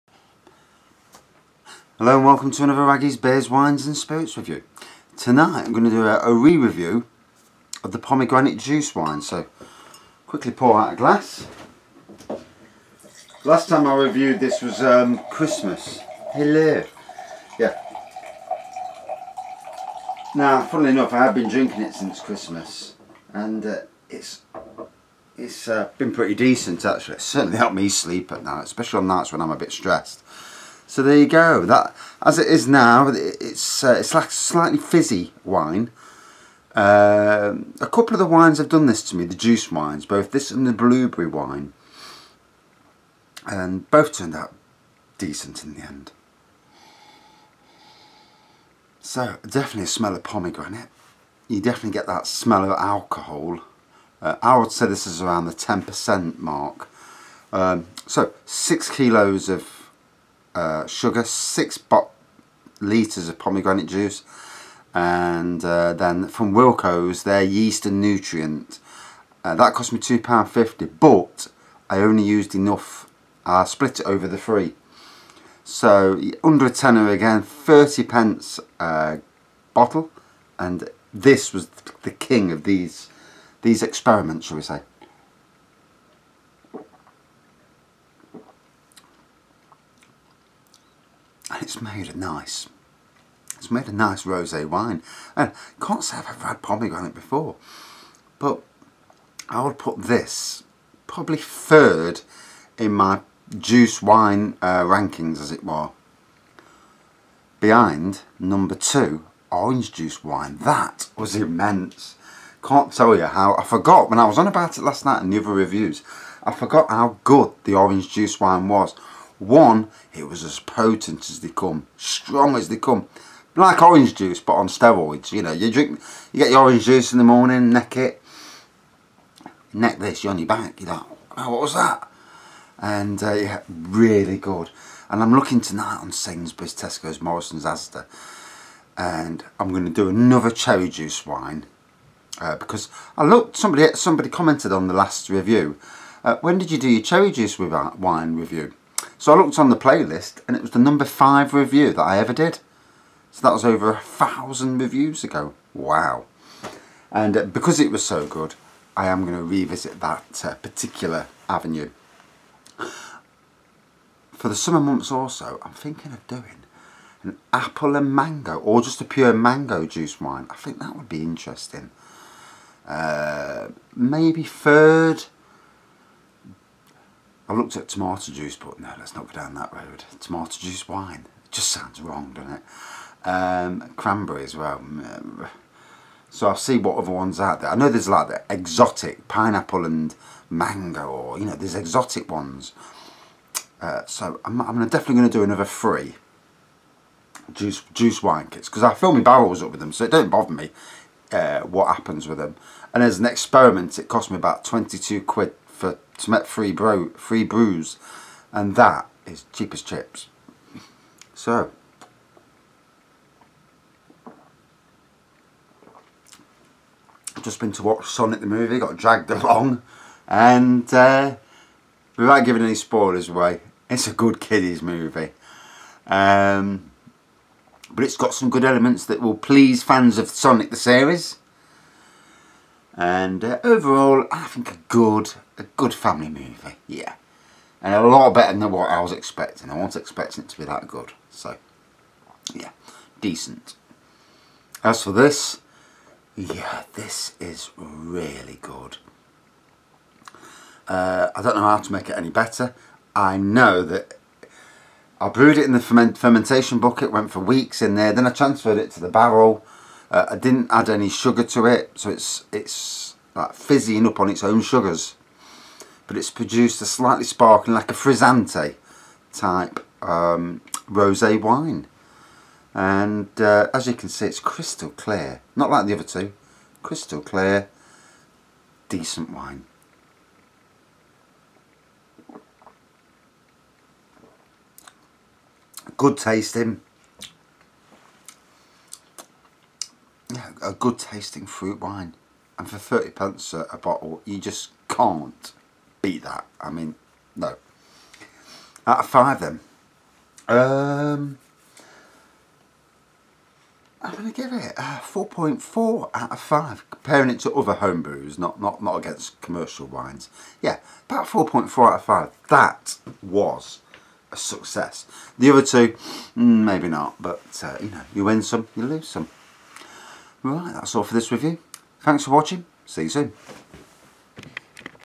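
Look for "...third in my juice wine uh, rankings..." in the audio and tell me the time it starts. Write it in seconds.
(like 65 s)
101 s.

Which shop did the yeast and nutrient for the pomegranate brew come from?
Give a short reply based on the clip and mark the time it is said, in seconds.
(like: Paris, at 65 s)
Wilko's, at 66 s.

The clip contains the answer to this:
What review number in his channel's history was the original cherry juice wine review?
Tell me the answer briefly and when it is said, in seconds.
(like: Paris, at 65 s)
5, at 150 s.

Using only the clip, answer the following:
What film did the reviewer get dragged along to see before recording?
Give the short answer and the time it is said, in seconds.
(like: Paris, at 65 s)
Sonic the movie, at 218 s.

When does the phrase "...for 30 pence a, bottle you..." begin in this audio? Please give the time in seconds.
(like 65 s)
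292 s.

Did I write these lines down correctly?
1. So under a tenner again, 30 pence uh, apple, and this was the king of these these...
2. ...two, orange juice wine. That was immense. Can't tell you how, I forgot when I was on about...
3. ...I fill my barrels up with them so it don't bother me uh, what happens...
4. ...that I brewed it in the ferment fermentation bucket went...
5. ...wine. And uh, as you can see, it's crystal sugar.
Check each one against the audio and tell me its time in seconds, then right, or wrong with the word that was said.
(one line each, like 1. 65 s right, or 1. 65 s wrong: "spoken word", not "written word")
1. 75 s wrong: "bottle", not "apple"
2. 108 s right
3. 198 s right
4. 253 s right
5. 271 s wrong: "clear", not "sugar".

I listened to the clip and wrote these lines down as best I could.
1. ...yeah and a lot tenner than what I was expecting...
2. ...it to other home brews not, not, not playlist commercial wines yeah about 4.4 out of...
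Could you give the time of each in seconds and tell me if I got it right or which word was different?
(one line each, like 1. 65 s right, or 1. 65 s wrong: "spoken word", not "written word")
1. 236 s wrong: "better", not "tenner"
2. 307 s wrong: "against", not "playlist".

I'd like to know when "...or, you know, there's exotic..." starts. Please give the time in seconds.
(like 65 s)
191 s.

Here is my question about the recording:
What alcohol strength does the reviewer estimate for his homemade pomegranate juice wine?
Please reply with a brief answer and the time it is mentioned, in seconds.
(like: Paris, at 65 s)
10%, at 55 s.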